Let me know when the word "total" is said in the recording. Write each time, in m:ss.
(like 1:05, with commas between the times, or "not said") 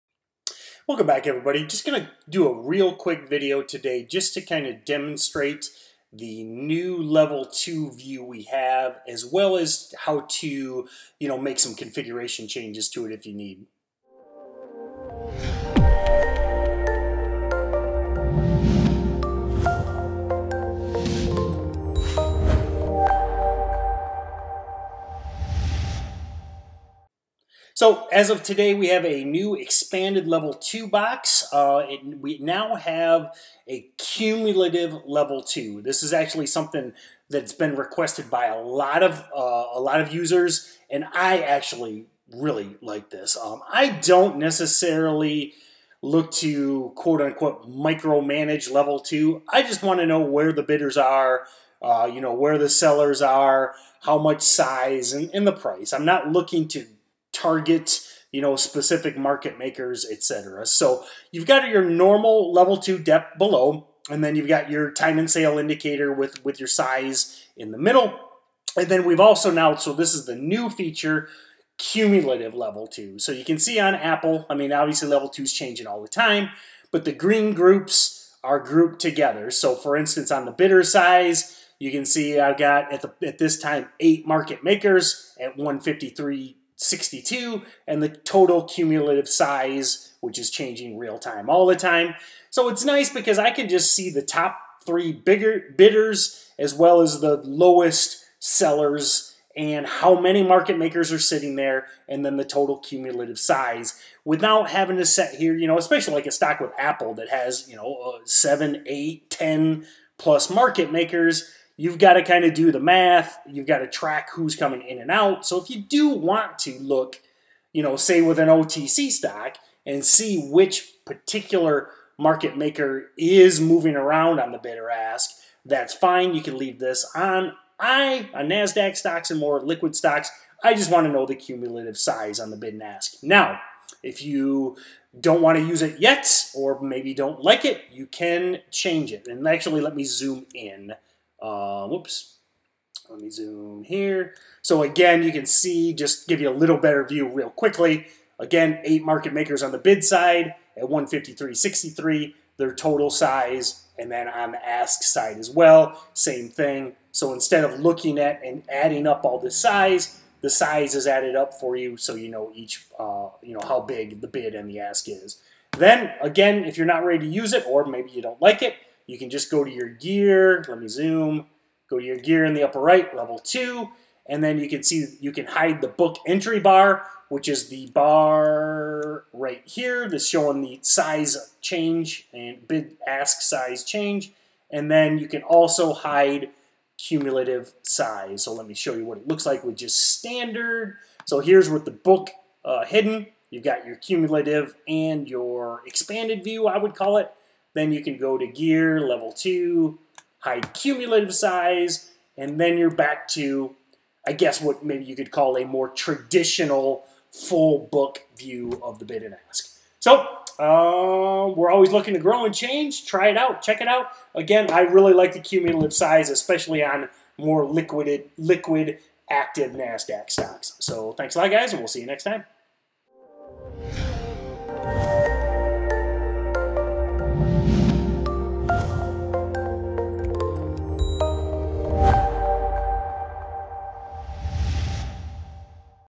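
1:28, 1:42, 2:32.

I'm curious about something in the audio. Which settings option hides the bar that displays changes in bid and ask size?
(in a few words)
hide the book entry bar.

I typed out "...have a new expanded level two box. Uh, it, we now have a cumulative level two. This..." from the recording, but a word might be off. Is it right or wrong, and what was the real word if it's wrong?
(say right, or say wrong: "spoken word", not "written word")
right.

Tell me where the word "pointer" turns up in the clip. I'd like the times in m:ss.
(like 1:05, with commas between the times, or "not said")
not said.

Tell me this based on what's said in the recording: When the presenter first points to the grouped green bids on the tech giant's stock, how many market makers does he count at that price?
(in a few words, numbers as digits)
8.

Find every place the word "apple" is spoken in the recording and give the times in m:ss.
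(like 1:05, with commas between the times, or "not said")
1:13, 1:46.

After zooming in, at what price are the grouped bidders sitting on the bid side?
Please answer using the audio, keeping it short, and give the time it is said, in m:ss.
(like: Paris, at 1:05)
153.63, at 2:30.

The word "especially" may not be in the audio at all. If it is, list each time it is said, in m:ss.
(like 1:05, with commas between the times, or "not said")
1:45, 3:36.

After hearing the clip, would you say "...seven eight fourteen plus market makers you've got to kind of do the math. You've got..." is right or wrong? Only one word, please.
wrong.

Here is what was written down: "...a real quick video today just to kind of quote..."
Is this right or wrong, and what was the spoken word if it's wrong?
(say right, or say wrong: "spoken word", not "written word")
wrong: "demonstrate", not "quote".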